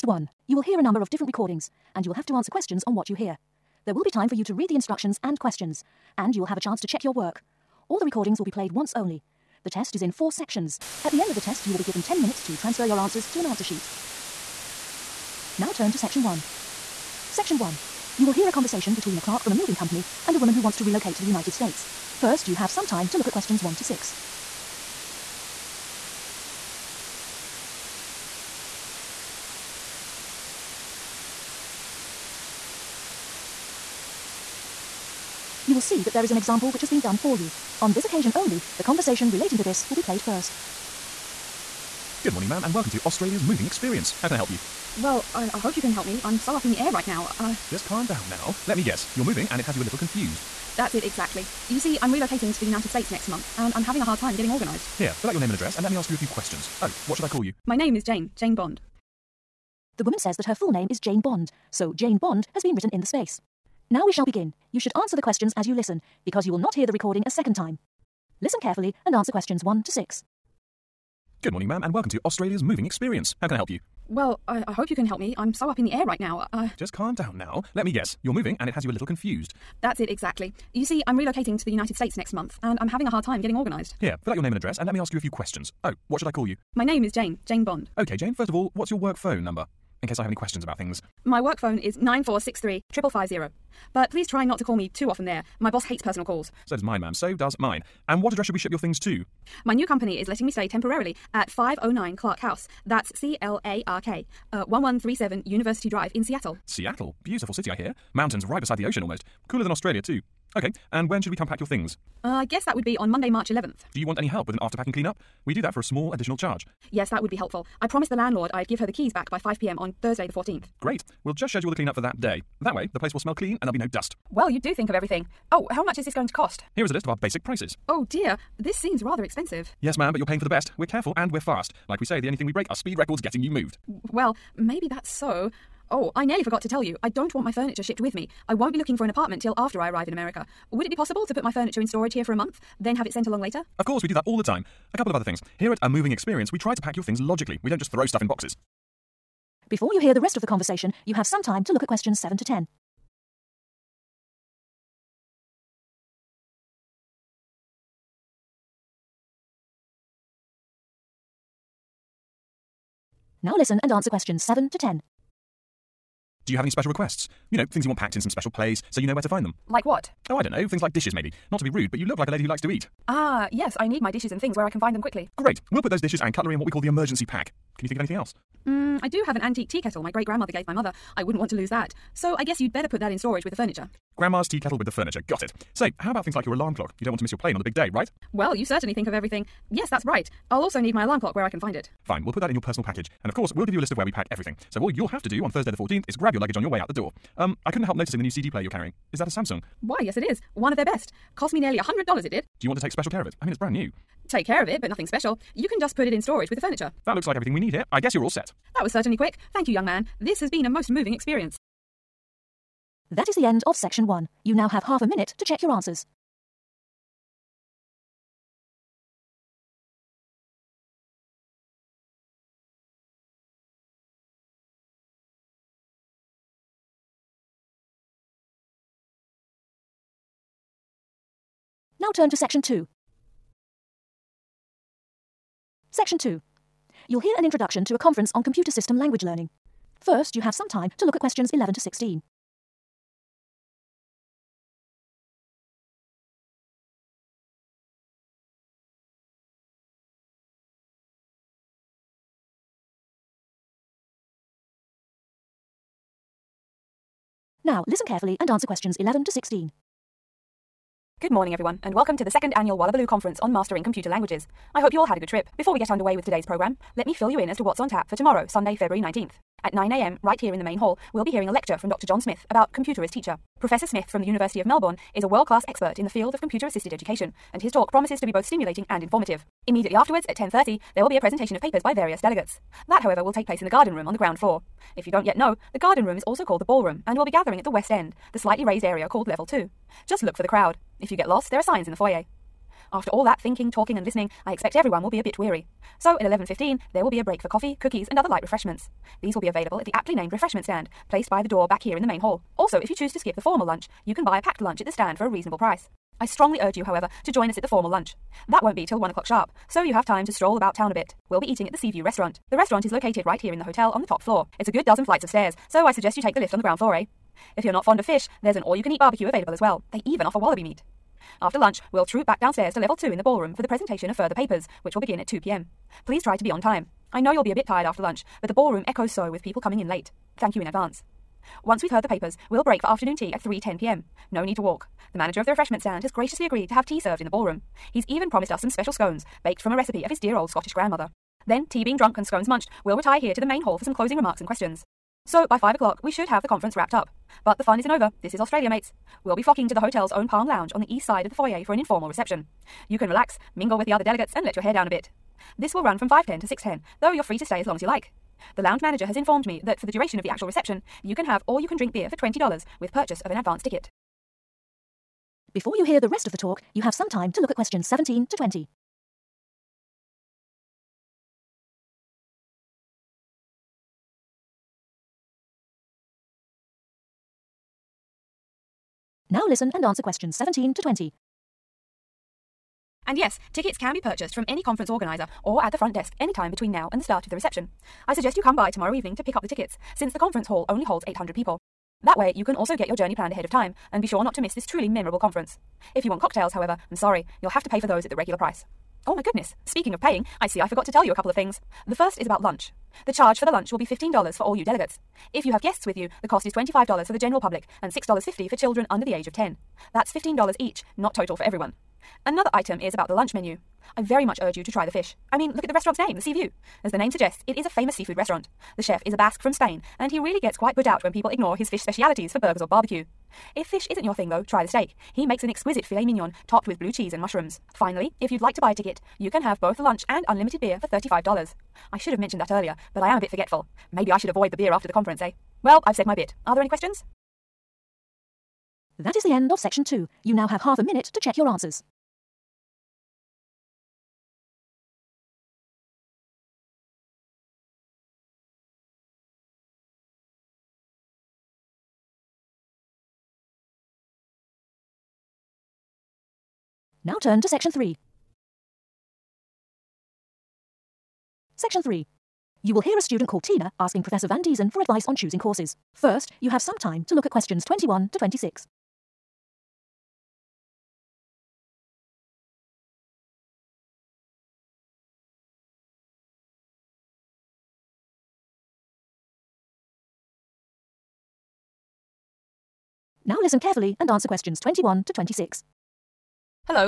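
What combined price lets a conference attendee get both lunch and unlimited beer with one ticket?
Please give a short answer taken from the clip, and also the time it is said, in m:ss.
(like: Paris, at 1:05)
$35, at 7:10.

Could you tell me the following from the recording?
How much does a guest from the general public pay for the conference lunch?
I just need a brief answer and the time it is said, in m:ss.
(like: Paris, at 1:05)
$25, at 6:46.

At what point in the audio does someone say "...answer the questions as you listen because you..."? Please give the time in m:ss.
1:04.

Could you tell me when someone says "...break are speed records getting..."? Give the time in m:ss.
2:12.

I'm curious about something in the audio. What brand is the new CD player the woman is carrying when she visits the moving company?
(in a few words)
Samsung.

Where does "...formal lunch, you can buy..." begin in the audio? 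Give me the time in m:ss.
5:03.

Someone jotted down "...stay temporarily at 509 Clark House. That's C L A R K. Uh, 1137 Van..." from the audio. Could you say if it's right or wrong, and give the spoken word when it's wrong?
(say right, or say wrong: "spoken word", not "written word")
wrong: "University", not "Van".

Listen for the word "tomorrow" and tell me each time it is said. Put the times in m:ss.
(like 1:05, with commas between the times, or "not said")
4:28, 6:28.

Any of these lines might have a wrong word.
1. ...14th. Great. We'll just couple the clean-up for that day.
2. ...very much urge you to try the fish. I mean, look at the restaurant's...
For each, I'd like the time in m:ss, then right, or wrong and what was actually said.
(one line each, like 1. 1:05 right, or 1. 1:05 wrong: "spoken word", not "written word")
1. 2:00 wrong: "schedule", not "couple"
2. 6:54 right.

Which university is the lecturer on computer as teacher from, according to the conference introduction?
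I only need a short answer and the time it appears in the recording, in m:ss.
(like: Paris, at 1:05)
University of Melbourne, at 4:34.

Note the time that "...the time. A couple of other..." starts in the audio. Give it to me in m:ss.
2:24.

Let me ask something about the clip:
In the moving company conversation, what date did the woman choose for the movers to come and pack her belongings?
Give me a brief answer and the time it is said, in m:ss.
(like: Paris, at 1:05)
Monday, March 11th, at 1:53.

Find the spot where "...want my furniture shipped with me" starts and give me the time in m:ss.
2:17.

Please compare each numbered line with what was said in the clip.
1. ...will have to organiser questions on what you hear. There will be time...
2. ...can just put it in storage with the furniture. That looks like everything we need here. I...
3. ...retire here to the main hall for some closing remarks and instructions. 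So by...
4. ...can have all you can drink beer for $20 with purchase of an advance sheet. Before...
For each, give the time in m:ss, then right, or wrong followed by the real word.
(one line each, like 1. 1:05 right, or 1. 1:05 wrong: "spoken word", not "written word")
1. 0:02 wrong: "answer", not "organiser"
2. 3:25 right
3. 5:42 wrong: "questions", not "instructions"
4. 6:01 wrong: "ticket", not "sheet".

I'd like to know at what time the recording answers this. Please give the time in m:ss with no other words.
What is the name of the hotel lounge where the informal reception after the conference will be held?
5:50.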